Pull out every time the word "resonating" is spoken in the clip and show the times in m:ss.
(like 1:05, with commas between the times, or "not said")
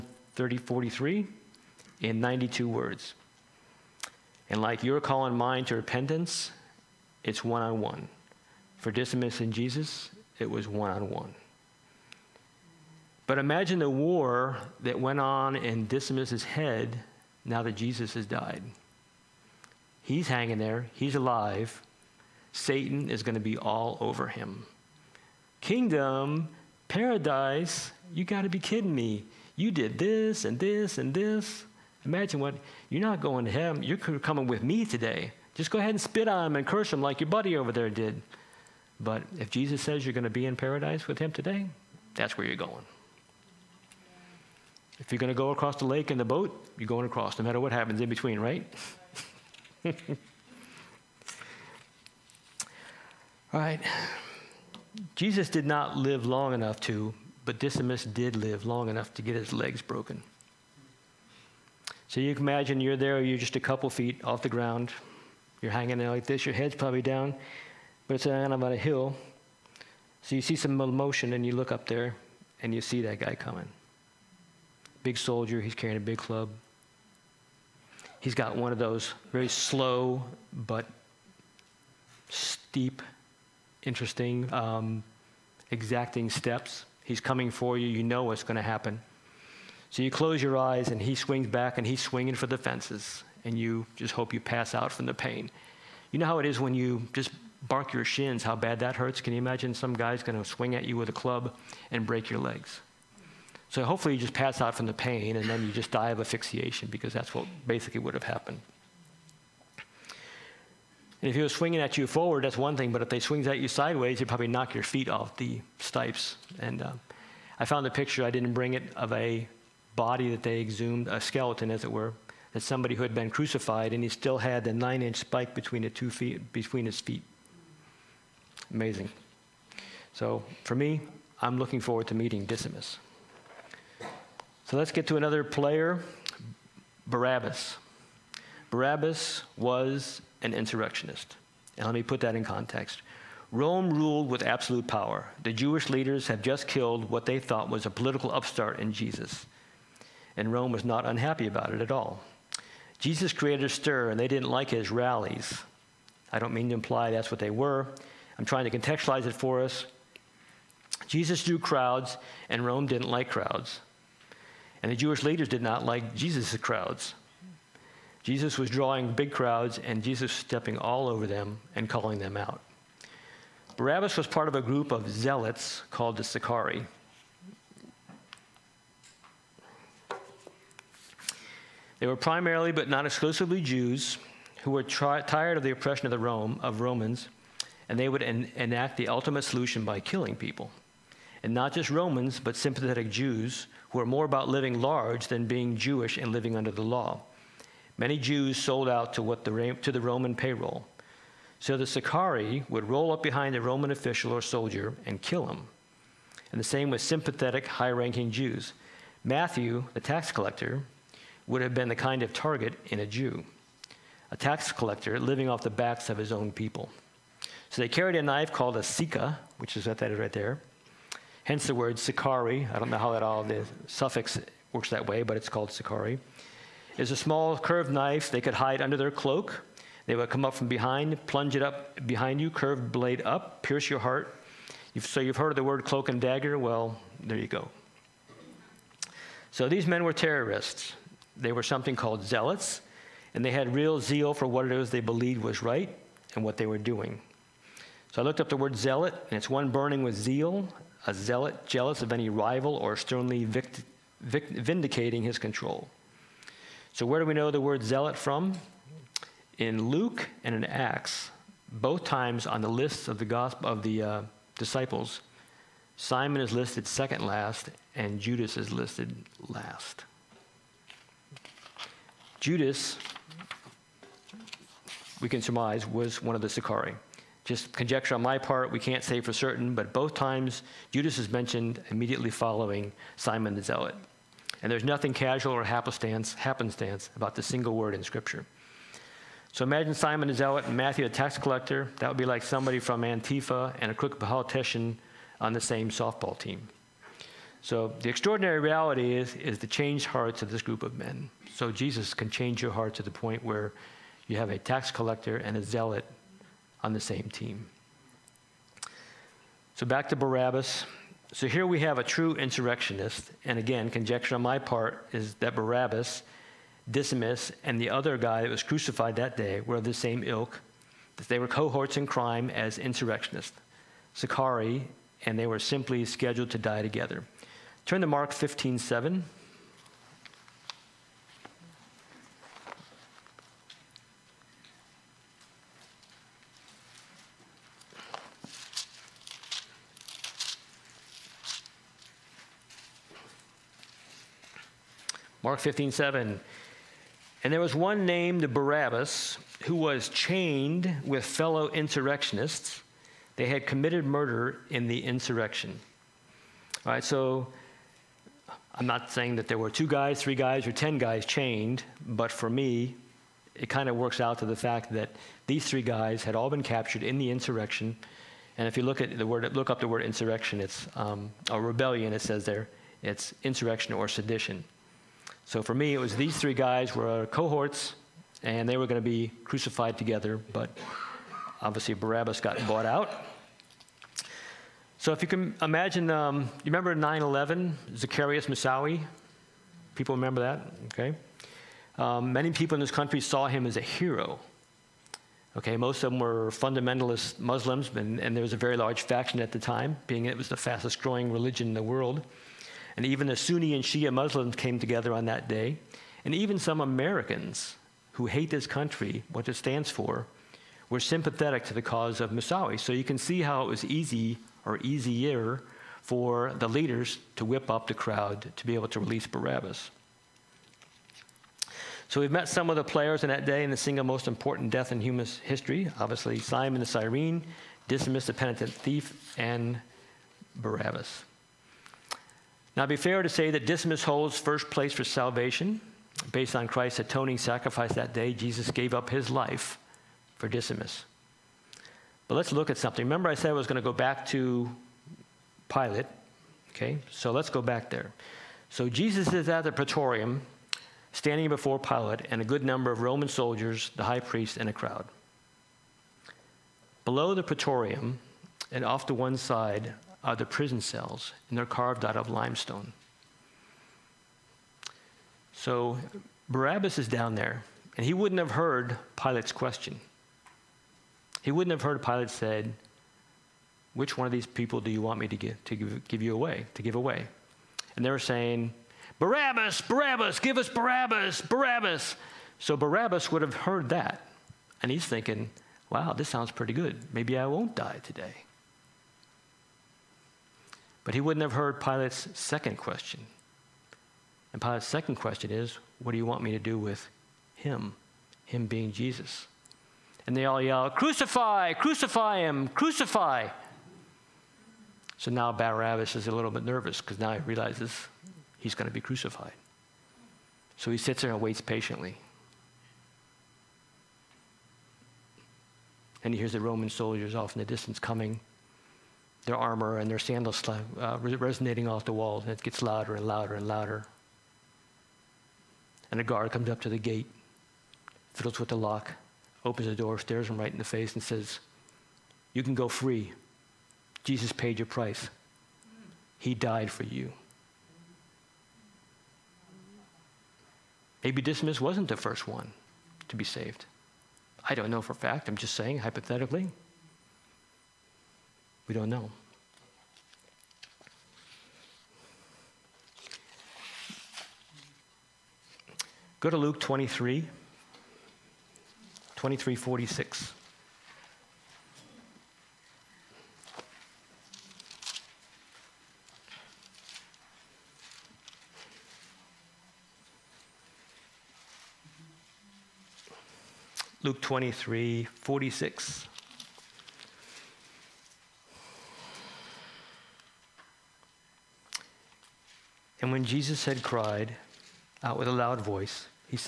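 8:41.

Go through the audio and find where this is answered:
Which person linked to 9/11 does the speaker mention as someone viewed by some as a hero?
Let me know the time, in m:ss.
6:27.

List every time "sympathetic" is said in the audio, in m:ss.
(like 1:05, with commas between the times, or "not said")
3:12, 3:27, 6:50.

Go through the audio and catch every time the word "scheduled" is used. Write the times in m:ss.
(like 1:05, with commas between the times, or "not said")
5:26.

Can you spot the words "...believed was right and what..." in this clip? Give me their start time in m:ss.
4:04.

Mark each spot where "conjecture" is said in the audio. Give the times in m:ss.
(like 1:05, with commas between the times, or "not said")
4:37, 5:13.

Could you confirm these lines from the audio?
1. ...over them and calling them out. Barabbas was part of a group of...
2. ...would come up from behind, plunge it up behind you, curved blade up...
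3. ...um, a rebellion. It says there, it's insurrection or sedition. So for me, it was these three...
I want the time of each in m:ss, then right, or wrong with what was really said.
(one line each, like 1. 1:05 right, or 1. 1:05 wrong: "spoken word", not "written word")
1. 2:51 right
2. 3:50 right
3. 6:10 right.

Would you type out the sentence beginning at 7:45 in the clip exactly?
So Barabbas is down there, and he wouldn't have heard Pilate's question.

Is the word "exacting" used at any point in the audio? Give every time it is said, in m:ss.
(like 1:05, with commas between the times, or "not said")
1:25.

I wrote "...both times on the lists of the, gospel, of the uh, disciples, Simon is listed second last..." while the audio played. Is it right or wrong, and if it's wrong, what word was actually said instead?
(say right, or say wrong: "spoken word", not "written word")
right.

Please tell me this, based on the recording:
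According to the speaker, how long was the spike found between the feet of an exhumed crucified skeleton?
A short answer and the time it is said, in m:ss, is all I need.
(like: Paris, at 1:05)
9 inches, at 2:04.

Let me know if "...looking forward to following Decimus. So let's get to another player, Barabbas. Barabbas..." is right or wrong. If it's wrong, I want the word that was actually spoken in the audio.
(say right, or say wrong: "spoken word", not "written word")
wrong: "meeting", not "following".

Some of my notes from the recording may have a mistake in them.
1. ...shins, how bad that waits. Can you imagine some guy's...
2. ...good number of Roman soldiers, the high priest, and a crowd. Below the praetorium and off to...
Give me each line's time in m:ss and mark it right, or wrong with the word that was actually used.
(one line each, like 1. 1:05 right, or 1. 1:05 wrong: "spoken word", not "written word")
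1. 1:38 wrong: "hurts", not "waits"
2. 7:32 right.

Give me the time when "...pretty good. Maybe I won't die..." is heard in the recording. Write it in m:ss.
8:06.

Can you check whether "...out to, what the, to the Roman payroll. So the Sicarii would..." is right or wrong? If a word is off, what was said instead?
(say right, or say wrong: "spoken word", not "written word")
right.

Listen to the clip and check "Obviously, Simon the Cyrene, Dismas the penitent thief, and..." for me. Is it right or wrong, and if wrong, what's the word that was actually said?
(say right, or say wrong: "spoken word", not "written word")
right.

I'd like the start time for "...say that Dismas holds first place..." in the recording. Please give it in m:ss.
7:13.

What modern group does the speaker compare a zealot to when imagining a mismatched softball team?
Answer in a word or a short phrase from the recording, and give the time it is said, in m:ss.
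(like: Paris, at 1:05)
Antifa, at 4:53.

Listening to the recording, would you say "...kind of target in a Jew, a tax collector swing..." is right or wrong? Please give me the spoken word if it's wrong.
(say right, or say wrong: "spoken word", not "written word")
wrong: "living", not "swing".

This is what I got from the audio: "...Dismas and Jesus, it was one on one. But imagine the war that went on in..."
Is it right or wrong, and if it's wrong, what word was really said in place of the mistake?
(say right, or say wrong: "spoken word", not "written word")
right.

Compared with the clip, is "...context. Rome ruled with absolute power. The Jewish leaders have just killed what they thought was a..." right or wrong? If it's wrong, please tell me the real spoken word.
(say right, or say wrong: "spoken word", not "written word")
right.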